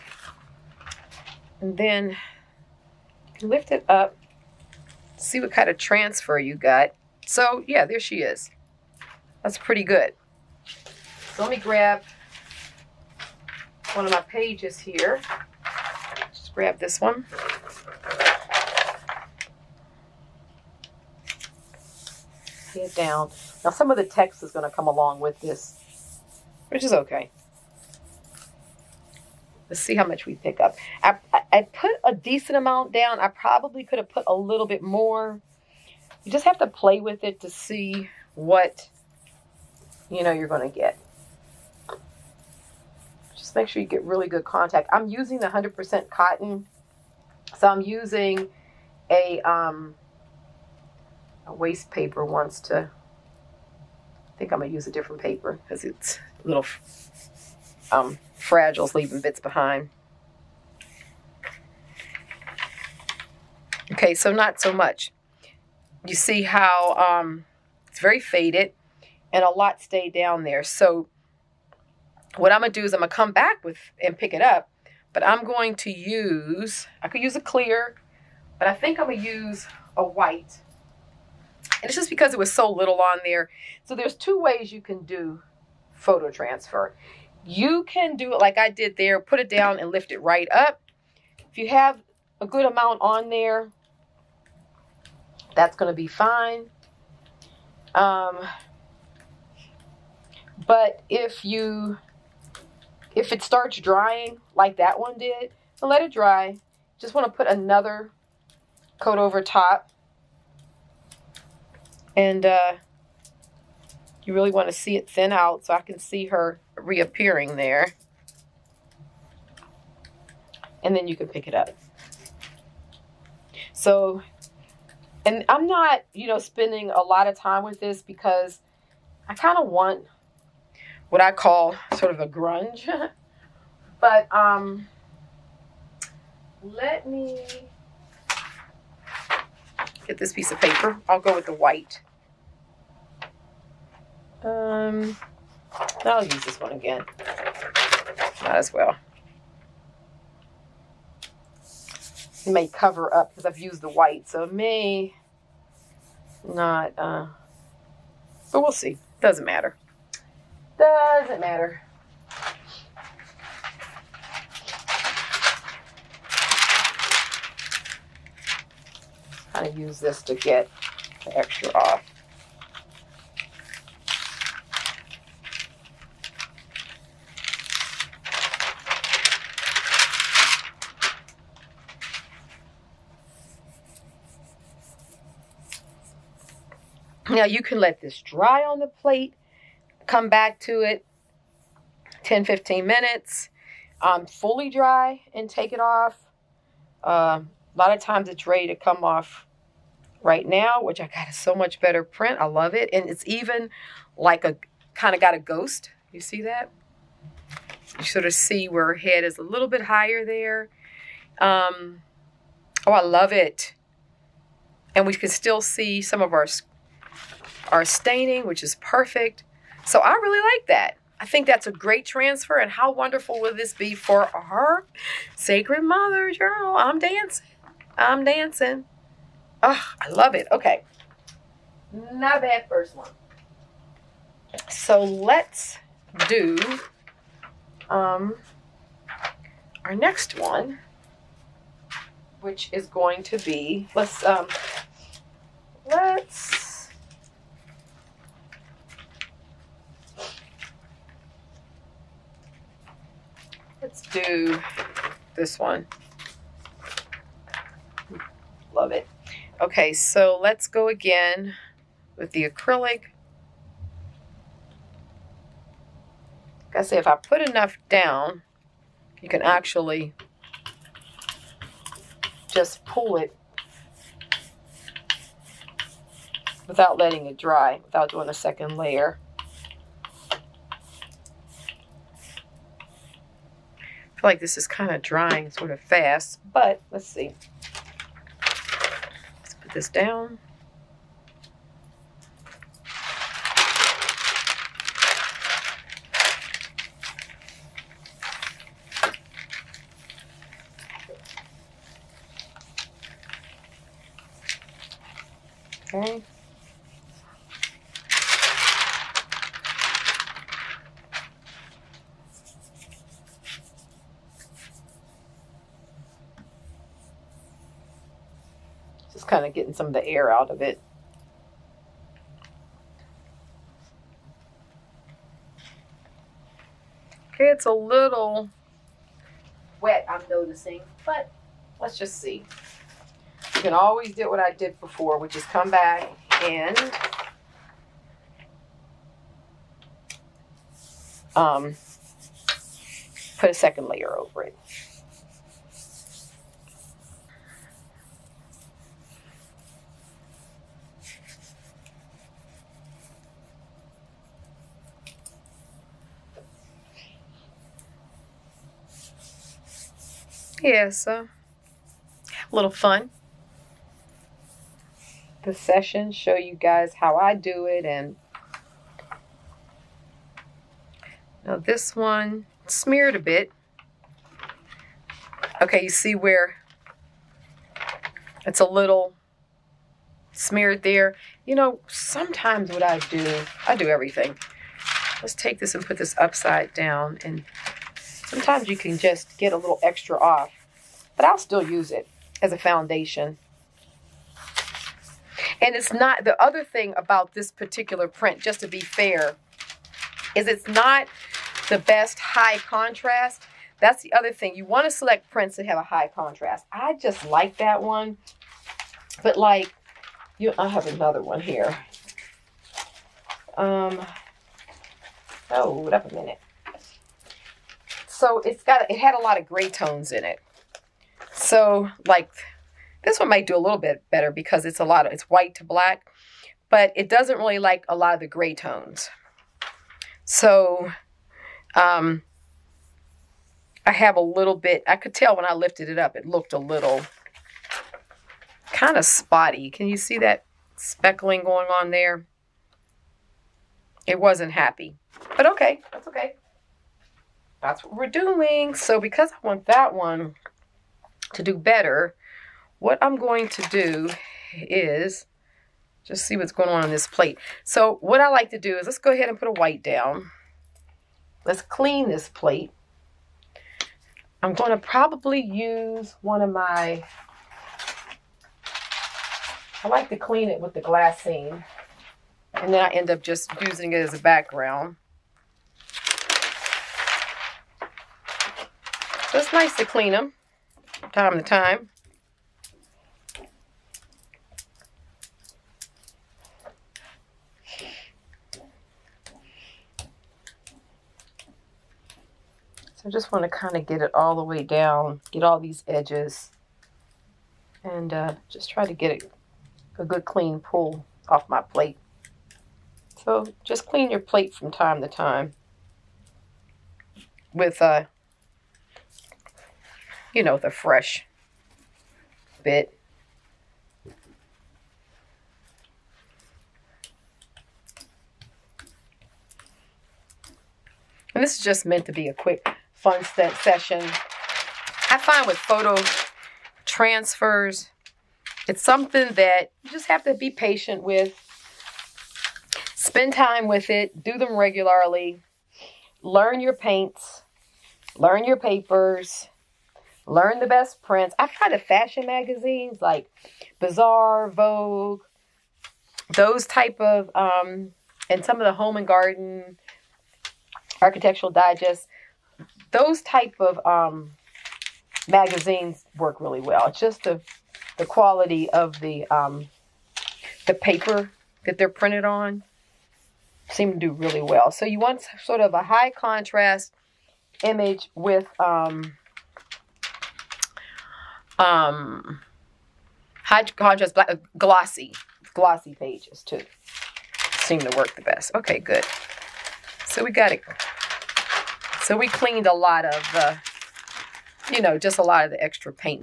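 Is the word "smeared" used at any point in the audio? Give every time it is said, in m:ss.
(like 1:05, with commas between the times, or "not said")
6:12, 6:20.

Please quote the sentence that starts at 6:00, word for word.
Yeah, uh, so a little fun.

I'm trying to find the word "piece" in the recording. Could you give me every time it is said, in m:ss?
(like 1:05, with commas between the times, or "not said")
2:20.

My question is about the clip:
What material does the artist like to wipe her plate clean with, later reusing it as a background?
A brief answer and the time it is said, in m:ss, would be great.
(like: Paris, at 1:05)
Glassine, at 7:50.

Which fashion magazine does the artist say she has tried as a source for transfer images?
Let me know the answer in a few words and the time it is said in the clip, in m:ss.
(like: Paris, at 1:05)
Bazaar, at 9:03.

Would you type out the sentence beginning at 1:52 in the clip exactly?
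And uh, you really want to see it thin out so I can see her reappearing there.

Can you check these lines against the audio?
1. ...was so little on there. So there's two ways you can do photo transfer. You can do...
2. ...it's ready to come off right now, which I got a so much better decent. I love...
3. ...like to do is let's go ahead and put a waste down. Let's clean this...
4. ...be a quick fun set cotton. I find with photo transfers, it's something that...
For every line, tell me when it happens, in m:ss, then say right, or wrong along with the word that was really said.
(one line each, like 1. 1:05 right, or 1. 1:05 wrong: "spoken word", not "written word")
1. 1:22 right
2. 3:18 wrong: "print", not "decent"
3. 7:38 wrong: "white", not "waste"
4. 8:42 wrong: "session", not "cotton".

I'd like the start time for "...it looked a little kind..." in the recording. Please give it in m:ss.
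7:16.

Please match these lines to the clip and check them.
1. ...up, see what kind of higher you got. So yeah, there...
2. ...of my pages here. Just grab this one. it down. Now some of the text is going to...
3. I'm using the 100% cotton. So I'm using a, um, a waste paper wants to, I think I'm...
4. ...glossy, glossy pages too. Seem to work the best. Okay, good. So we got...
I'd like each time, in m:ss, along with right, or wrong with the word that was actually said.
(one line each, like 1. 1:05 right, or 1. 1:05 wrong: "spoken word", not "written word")
1. 0:03 wrong: "transfer", not "higher"
2. 0:14 right
3. 0:44 right
4. 9:34 right.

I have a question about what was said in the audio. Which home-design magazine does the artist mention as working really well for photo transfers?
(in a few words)
Architectural Digest.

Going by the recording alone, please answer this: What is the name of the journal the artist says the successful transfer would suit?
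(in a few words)
Sacred Mother Journal.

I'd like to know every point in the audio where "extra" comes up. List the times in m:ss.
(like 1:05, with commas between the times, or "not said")
2:51, 6:29, 9:45.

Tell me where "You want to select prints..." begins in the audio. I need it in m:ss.
6:44.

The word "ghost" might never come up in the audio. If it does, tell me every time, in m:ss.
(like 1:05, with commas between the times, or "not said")
3:25.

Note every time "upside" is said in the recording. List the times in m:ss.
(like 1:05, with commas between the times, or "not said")
6:26.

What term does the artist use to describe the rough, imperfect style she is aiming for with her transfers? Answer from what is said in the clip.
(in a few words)
Grunge.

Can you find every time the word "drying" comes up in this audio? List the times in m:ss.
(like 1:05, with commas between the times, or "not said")
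1:43, 4:45.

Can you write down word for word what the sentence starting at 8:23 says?
So just clean your plate from time to time with uh, you know, the fresh bit.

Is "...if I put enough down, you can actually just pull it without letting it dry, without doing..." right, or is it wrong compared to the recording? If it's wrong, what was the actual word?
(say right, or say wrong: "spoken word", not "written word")
right.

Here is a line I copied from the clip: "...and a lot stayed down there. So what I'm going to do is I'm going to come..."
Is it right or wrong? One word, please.
right.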